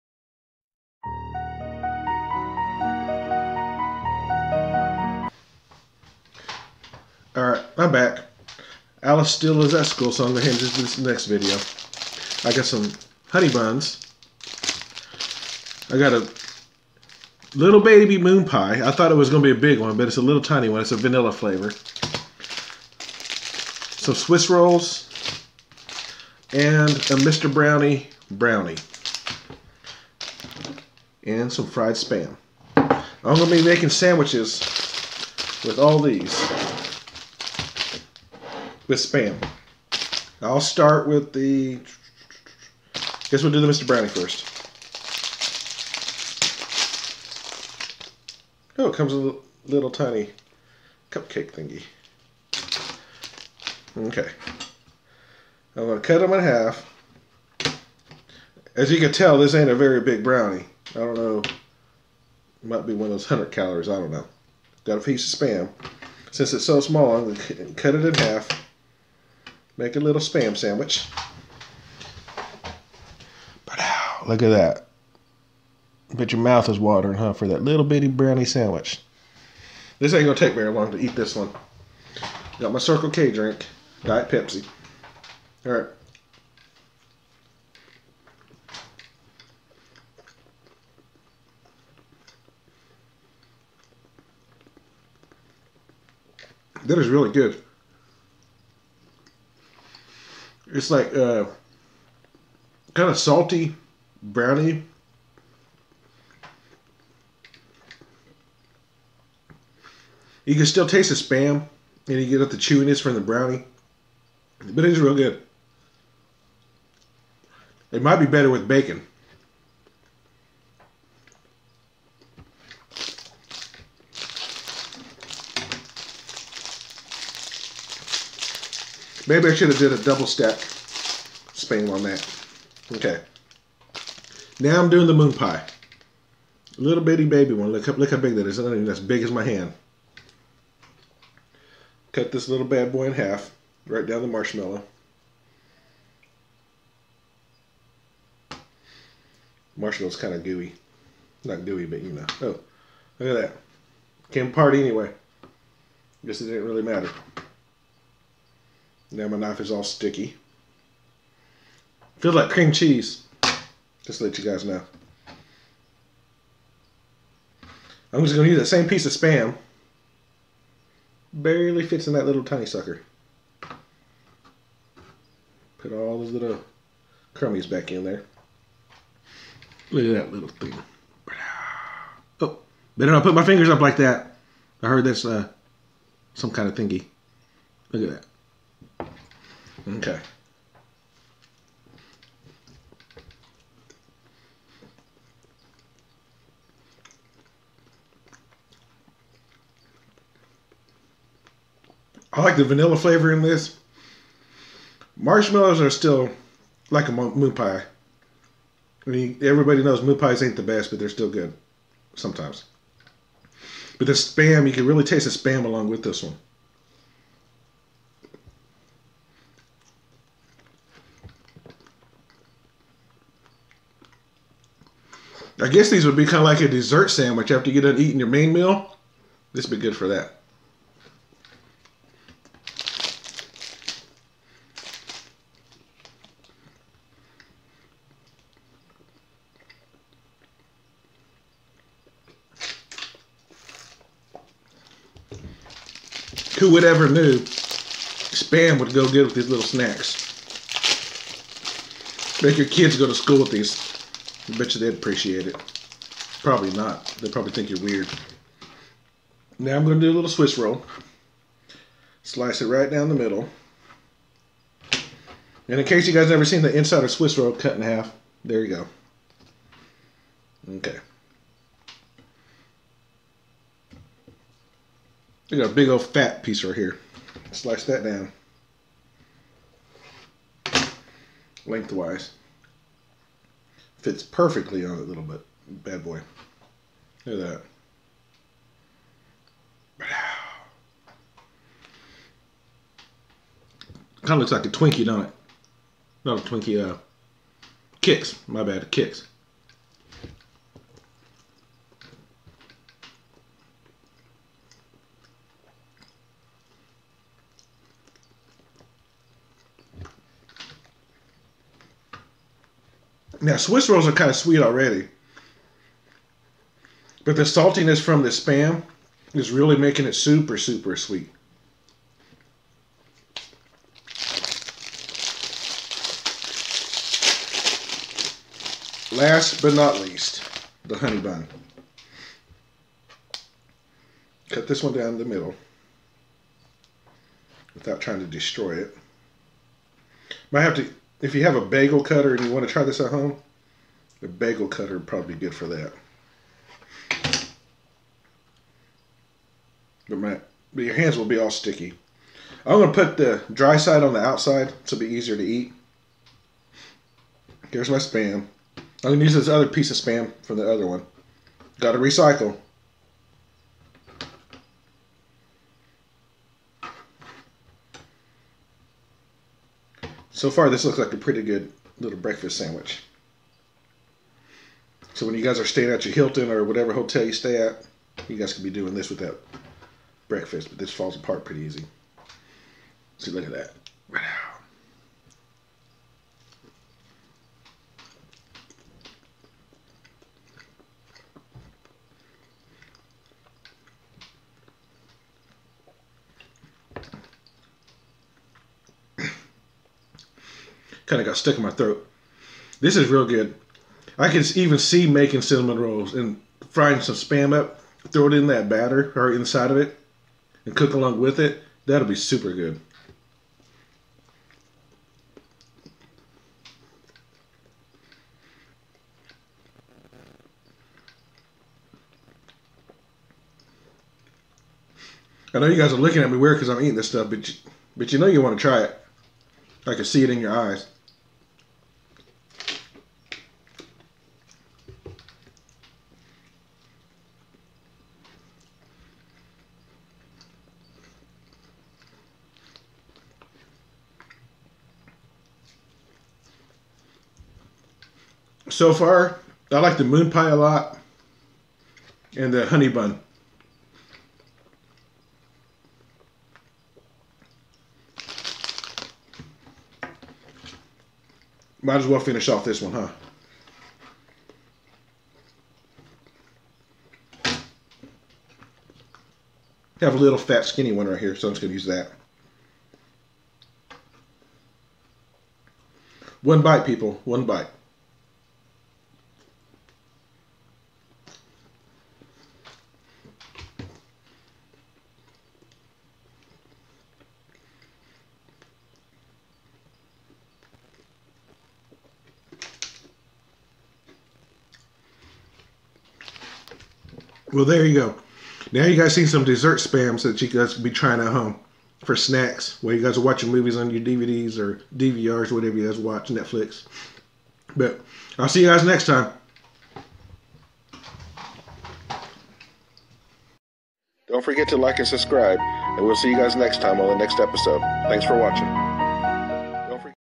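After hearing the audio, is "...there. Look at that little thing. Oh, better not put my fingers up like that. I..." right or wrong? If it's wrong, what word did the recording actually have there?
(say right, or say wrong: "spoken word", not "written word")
right.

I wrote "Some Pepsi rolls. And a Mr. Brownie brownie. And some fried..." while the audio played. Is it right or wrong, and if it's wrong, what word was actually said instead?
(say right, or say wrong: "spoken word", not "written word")
wrong: "Swiss", not "Pepsi".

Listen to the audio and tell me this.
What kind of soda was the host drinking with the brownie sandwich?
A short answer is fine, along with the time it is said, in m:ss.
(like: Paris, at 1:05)
Diet Pepsi, at 1:24.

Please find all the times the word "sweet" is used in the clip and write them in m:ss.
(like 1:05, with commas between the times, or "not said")
5:14, 5:20.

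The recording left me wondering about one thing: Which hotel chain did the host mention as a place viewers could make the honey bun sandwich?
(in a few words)
Hilton.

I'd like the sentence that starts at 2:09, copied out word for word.
Maybe I should have did a double stack spam on that.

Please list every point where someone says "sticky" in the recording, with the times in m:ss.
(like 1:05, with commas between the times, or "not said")
2:39, 5:51.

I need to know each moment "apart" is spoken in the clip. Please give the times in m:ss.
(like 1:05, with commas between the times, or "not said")
2:34, 6:21.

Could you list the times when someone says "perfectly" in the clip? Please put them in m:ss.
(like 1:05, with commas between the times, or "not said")
4:44.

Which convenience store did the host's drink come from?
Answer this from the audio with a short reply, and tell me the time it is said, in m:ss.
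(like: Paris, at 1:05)
Circle K, at 1:22.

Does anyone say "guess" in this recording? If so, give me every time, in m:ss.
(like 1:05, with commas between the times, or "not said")
0:43, 2:36, 3:45.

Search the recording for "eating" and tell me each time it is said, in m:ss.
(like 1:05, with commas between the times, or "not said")
3:48, 7:06.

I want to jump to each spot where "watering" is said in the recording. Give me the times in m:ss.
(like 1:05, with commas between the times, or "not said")
1:16.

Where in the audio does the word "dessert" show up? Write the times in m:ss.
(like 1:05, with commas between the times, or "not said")
3:46, 8:19.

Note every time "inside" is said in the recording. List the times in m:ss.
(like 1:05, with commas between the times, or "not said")
4:26, 6:49.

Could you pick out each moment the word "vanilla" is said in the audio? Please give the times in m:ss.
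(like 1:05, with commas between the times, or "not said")
0:20, 3:22.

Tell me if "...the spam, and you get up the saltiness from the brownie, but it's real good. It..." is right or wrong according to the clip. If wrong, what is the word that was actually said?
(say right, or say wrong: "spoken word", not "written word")
wrong: "chewiness", not "saltiness".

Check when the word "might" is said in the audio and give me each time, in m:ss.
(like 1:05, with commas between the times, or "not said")
1:02, 1:58, 5:40, 7:41.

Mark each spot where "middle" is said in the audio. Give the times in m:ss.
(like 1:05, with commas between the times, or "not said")
4:23, 5:35.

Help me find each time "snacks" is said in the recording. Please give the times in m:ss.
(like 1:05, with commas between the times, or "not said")
4:09, 8:22.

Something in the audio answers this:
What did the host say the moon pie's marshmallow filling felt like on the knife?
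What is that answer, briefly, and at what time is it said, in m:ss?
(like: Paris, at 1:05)
Cream cheese, at 2:42.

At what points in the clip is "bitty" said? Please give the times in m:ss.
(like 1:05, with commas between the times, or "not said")
1:17, 2:17.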